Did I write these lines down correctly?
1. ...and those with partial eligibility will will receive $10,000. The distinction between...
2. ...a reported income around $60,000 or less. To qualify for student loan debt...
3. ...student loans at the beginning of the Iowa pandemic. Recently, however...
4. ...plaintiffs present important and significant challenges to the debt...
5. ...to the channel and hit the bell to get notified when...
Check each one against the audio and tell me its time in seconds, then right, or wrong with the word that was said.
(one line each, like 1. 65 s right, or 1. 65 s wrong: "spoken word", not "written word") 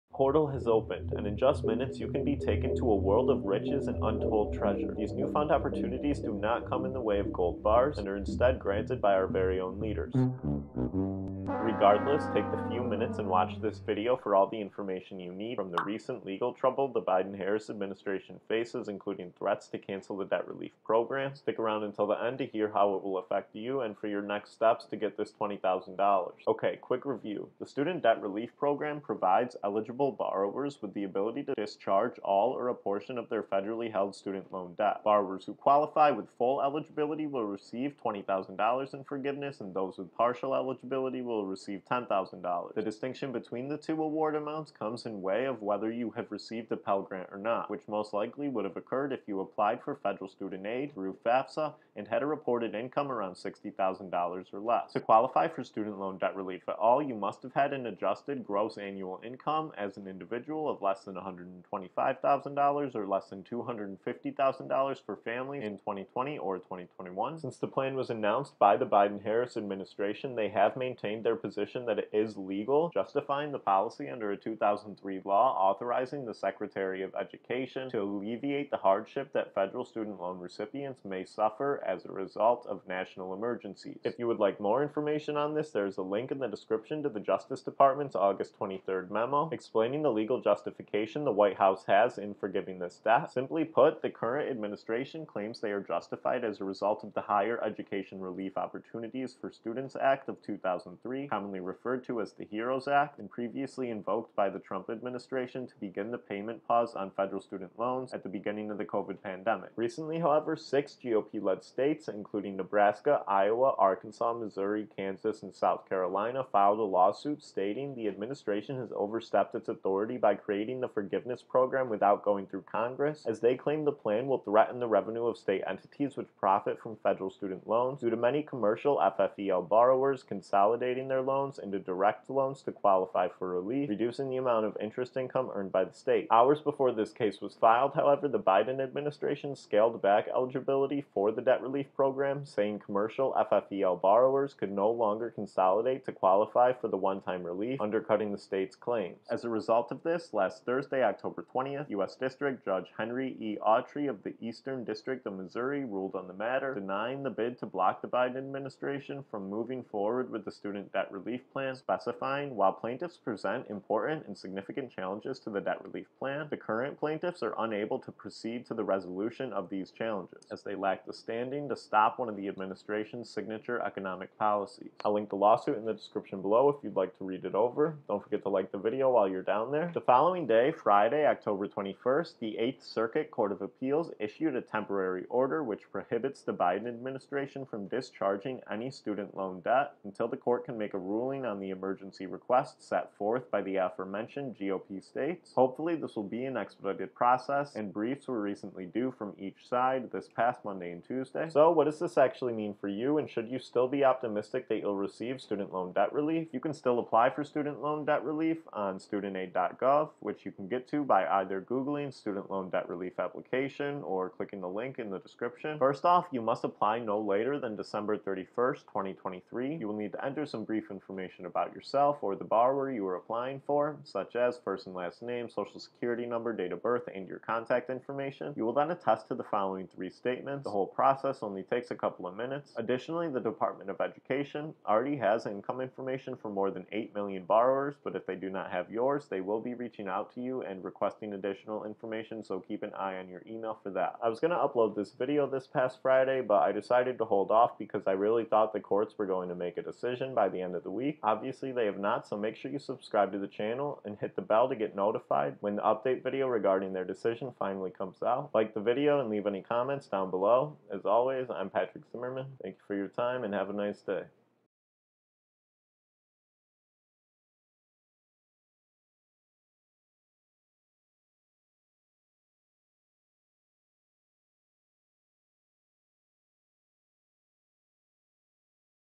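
1. 39 s right
2. 52 s right
3. 107 s wrong: "COVID", not "Iowa"
4. 162 s right
5. 253 s right.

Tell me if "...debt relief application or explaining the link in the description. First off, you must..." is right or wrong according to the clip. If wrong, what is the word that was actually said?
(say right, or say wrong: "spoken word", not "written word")
wrong: "clicking", not "explaining".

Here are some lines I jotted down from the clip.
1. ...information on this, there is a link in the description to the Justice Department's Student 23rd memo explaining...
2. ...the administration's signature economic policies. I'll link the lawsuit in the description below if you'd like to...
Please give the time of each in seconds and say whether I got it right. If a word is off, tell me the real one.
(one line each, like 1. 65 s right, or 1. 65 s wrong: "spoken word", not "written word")
1. 84 s wrong: "August", not "Student"
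2. 172 s right.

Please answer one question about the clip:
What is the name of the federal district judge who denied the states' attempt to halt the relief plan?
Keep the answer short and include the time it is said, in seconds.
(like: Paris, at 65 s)
Henry E. Autrey, at 152 s.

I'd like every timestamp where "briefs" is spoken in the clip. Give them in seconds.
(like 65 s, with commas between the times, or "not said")
197 s, 220 s.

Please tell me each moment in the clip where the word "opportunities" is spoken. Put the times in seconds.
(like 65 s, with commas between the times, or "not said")
5 s, 98 s.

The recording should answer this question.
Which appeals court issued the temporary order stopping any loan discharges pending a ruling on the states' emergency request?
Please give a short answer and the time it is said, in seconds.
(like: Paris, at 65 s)
Eighth Circuit Court of Appeals, at 182 s.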